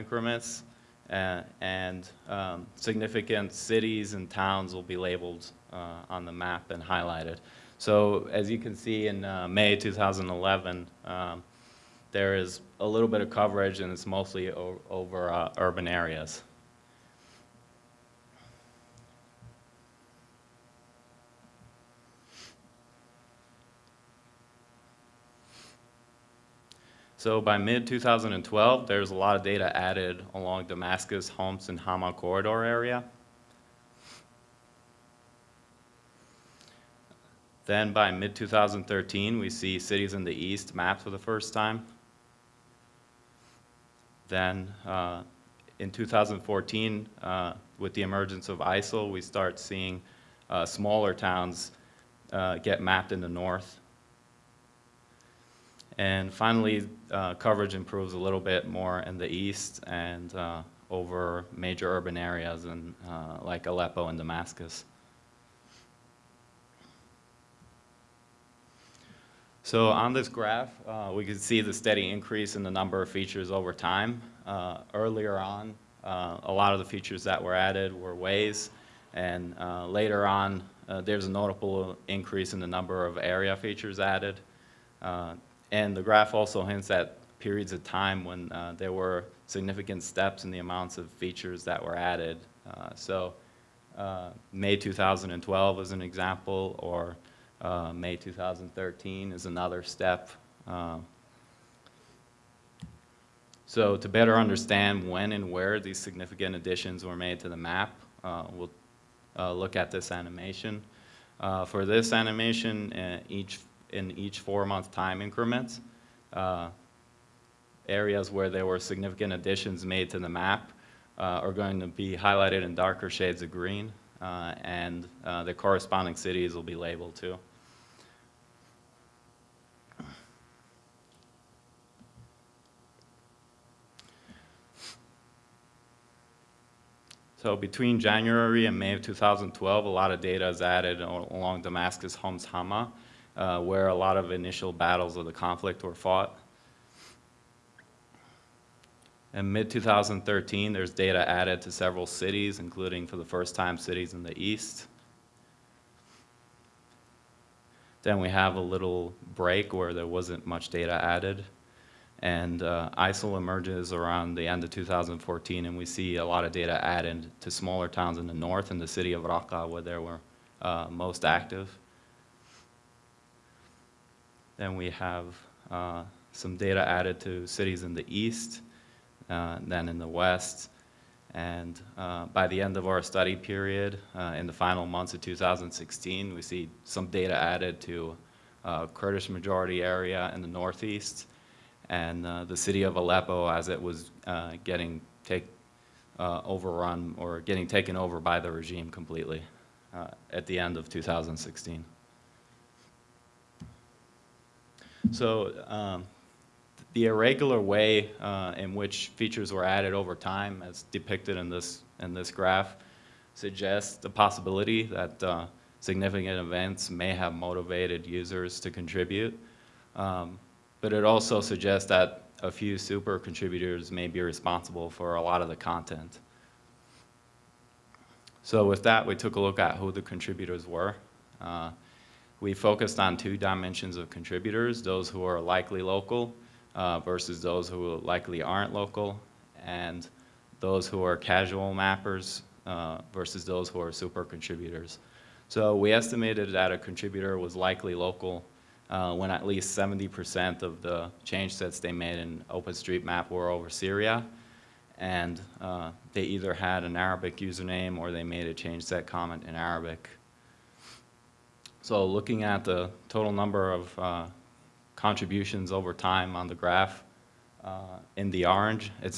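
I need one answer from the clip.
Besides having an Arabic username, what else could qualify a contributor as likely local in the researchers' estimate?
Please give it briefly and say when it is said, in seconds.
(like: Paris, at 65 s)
Change set comment in Arabic, at 258 s.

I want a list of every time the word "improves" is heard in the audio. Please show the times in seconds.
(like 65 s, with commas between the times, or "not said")
57 s.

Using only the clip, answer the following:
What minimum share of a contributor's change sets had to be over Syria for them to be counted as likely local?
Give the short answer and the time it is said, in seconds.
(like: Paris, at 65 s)
70%, at 249 s.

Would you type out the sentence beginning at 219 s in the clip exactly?
Um, but it also suggests that a few super contributors may be responsible for a lot of the content.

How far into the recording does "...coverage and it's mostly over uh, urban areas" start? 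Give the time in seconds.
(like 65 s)
13 s.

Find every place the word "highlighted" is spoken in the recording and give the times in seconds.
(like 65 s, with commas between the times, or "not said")
6 s, 122 s.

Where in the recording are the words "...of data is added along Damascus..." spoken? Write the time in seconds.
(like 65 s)
140 s.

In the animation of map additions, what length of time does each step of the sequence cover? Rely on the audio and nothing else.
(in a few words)
4 months.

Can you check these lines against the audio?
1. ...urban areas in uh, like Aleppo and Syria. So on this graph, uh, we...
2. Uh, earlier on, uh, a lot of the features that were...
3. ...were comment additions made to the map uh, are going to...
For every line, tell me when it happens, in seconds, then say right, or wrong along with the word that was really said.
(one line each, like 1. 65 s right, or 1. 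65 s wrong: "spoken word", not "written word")
1. 61 s wrong: "Damascus", not "Syria"
2. 74 s right
3. 118 s wrong: "significant", not "comment".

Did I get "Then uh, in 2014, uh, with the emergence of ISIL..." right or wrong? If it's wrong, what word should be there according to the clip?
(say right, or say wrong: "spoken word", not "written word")
right.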